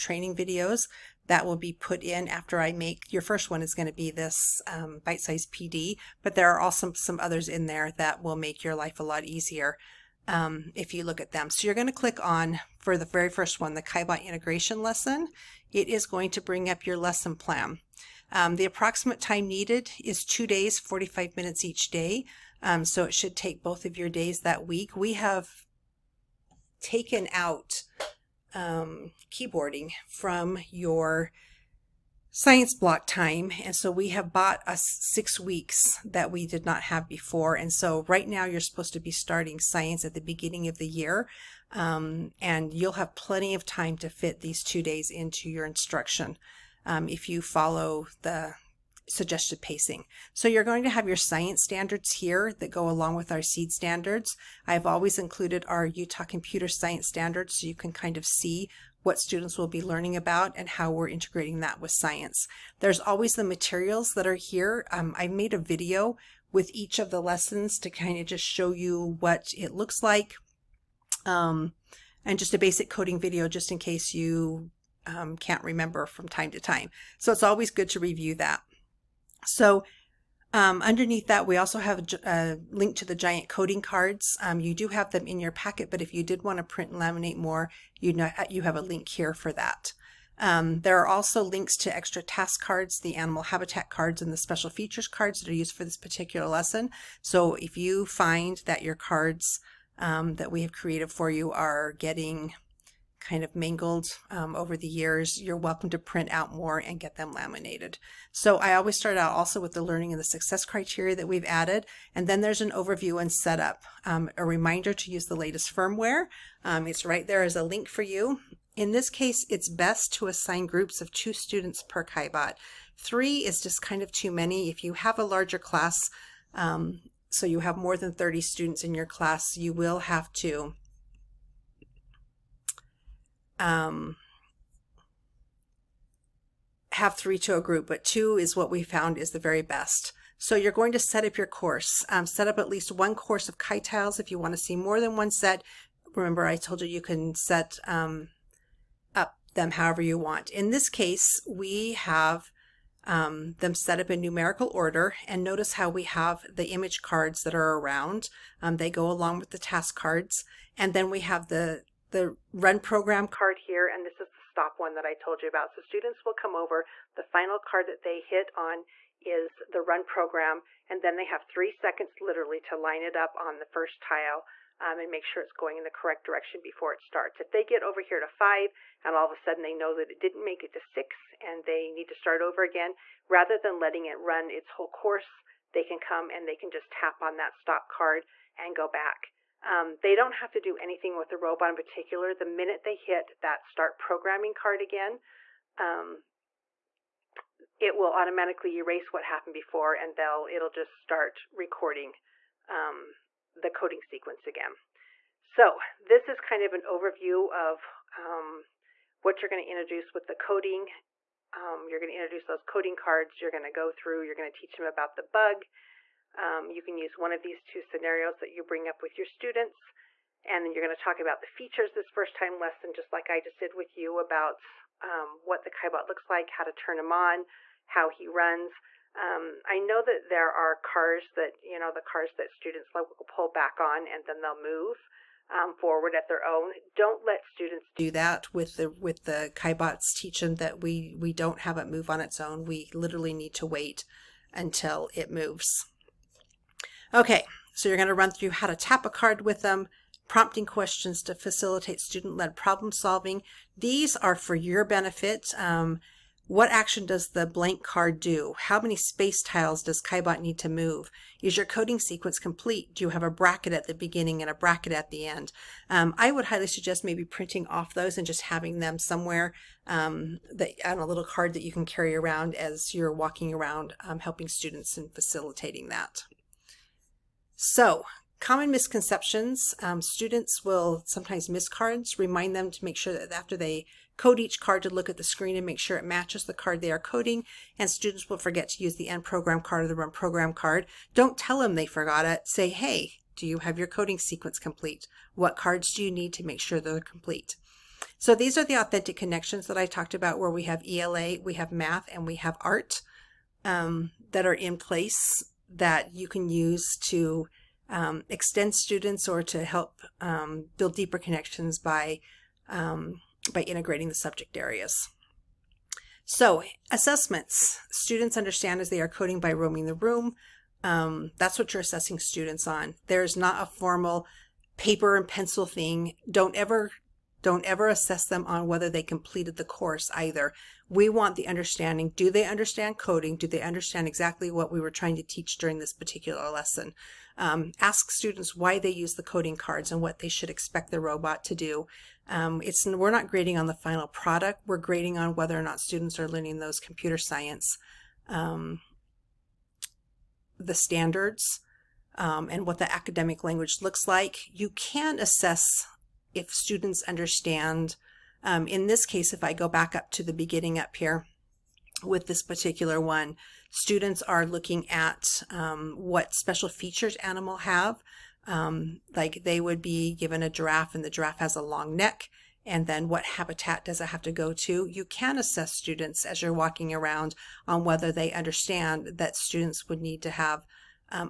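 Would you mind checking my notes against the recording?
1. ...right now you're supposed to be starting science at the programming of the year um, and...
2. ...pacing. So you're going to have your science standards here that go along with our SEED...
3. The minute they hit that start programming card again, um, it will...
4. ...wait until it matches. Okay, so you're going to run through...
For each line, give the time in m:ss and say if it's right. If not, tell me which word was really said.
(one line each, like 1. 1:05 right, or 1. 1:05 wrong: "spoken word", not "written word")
1. 0:38 wrong: "beginning", not "programming"
2. 0:49 right
3. 3:12 right
4. 4:03 wrong: "moves", not "matches".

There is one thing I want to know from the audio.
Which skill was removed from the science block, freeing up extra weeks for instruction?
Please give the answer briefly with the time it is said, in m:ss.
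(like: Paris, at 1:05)
Keyboarding, at 0:29.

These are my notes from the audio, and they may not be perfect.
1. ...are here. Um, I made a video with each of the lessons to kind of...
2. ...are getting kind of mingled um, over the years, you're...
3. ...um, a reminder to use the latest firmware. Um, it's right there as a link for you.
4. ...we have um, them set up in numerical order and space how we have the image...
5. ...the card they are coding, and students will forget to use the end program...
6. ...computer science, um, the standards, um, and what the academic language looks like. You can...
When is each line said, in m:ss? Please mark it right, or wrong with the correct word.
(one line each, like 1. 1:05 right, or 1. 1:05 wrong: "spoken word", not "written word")
1. 1:04 right
2. 1:41 right
3. 1:54 right
4. 2:31 wrong: "notice", not "space"
5. 4:46 right
6. 5:46 right.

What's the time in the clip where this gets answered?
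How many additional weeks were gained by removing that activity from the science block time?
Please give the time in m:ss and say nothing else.
0:34.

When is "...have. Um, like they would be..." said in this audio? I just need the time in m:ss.
6:07.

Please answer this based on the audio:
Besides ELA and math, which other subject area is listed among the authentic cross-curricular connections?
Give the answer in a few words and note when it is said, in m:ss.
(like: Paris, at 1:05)
Art, at 5:02.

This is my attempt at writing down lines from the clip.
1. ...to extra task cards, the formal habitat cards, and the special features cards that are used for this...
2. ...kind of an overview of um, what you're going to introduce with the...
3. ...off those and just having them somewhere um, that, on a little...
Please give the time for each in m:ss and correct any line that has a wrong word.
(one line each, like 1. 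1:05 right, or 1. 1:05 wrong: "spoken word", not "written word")
1. 1:31 wrong: "animal", not "formal"
2. 3:26 right
3. 4:27 right.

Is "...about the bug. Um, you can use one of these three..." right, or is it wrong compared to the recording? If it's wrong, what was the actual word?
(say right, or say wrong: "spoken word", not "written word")
wrong: "two", not "three".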